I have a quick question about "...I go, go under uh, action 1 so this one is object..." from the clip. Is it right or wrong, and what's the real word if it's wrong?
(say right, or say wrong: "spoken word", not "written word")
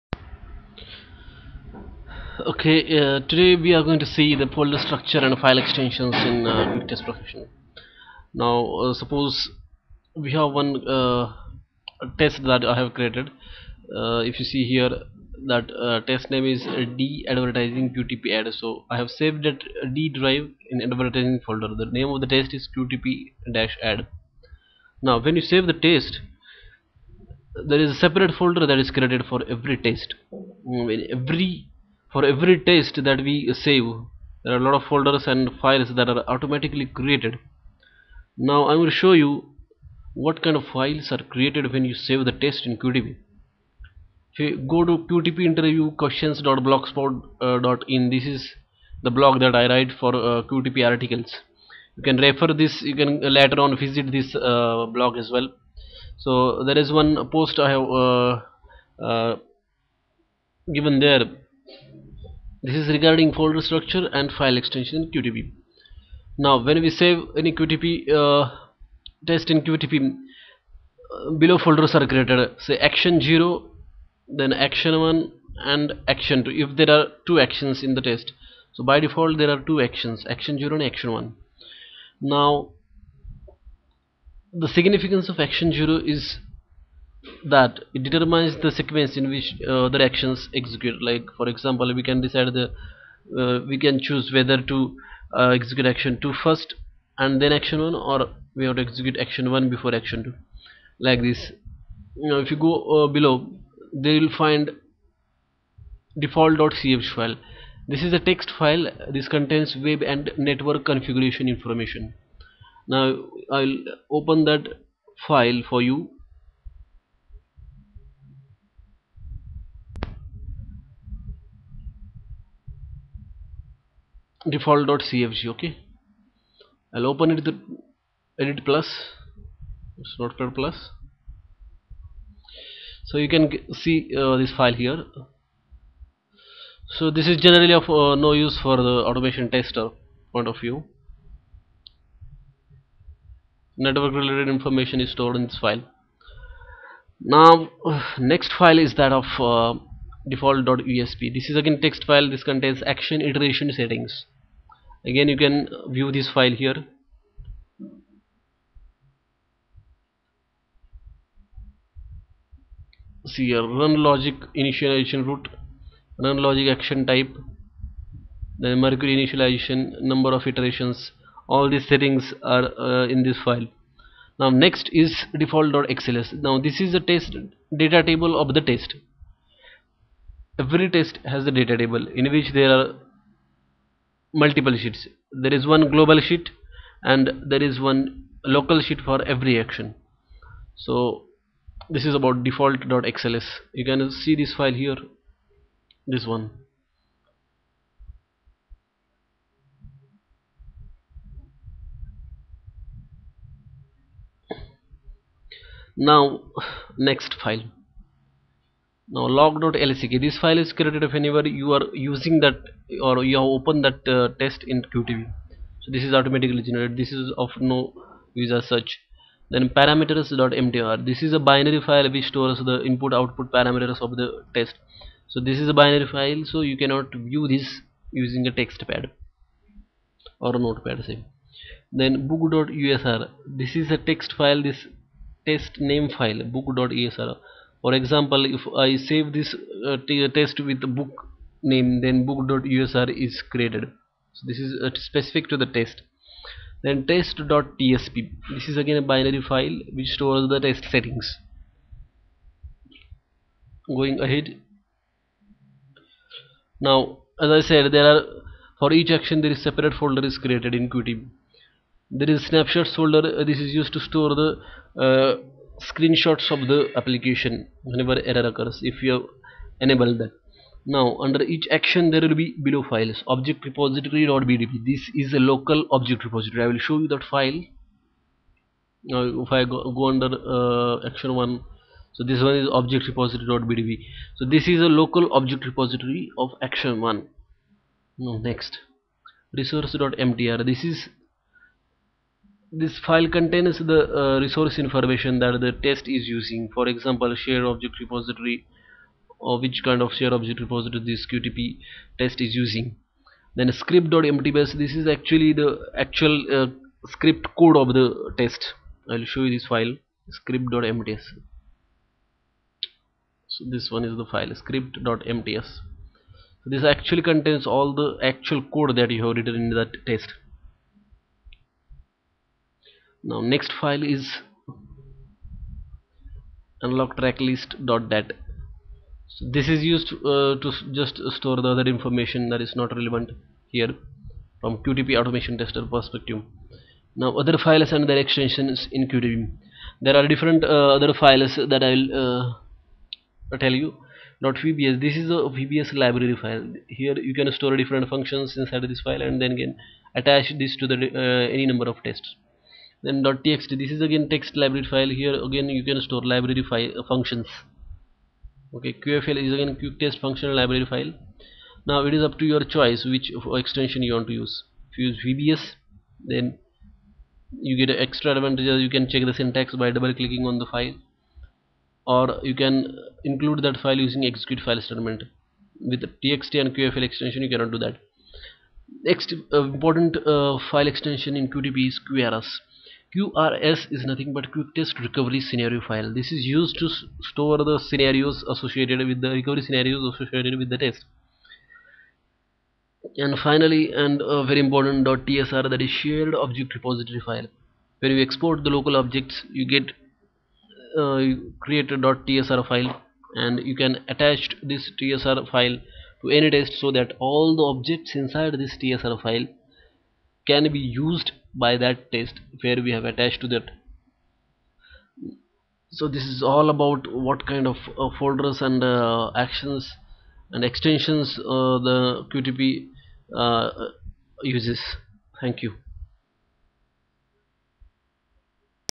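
right.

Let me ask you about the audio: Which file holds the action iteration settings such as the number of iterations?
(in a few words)
default.usp.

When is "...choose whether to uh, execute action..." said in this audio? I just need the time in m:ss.
1:33.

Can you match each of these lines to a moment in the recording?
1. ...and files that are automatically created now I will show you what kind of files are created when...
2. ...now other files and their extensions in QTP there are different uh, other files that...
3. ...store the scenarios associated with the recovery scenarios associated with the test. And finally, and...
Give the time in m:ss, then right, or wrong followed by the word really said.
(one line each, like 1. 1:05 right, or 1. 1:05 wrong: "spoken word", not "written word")
1. 0:35 right
2. 5:37 right
3. 6:27 right.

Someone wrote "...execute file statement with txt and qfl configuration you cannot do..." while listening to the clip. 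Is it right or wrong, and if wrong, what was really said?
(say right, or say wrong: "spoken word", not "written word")
wrong: "extension", not "configuration".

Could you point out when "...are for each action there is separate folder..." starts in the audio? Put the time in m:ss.
4:18.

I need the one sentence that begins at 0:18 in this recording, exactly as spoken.
so I have saved that d drive in advertising folder the name of the test is QTP dash Add.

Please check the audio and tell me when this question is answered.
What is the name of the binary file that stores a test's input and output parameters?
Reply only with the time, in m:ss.
3:39.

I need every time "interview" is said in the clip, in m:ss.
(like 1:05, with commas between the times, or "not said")
0:45.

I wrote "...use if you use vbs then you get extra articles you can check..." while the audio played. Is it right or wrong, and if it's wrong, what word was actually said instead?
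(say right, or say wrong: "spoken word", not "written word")
wrong: "advantages", not "articles".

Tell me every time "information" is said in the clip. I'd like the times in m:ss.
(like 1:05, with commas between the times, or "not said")
1:51, 2:24, 4:54, 5:31.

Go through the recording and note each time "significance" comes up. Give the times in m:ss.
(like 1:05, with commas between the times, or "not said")
1:24.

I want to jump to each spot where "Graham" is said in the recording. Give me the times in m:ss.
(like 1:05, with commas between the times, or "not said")
not said.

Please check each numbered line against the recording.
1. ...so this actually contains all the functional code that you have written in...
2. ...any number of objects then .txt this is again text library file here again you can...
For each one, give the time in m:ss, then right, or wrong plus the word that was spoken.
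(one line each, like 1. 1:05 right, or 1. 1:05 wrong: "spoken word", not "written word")
1. 5:16 wrong: "actual", not "functional"
2. 5:51 wrong: "tests", not "objects".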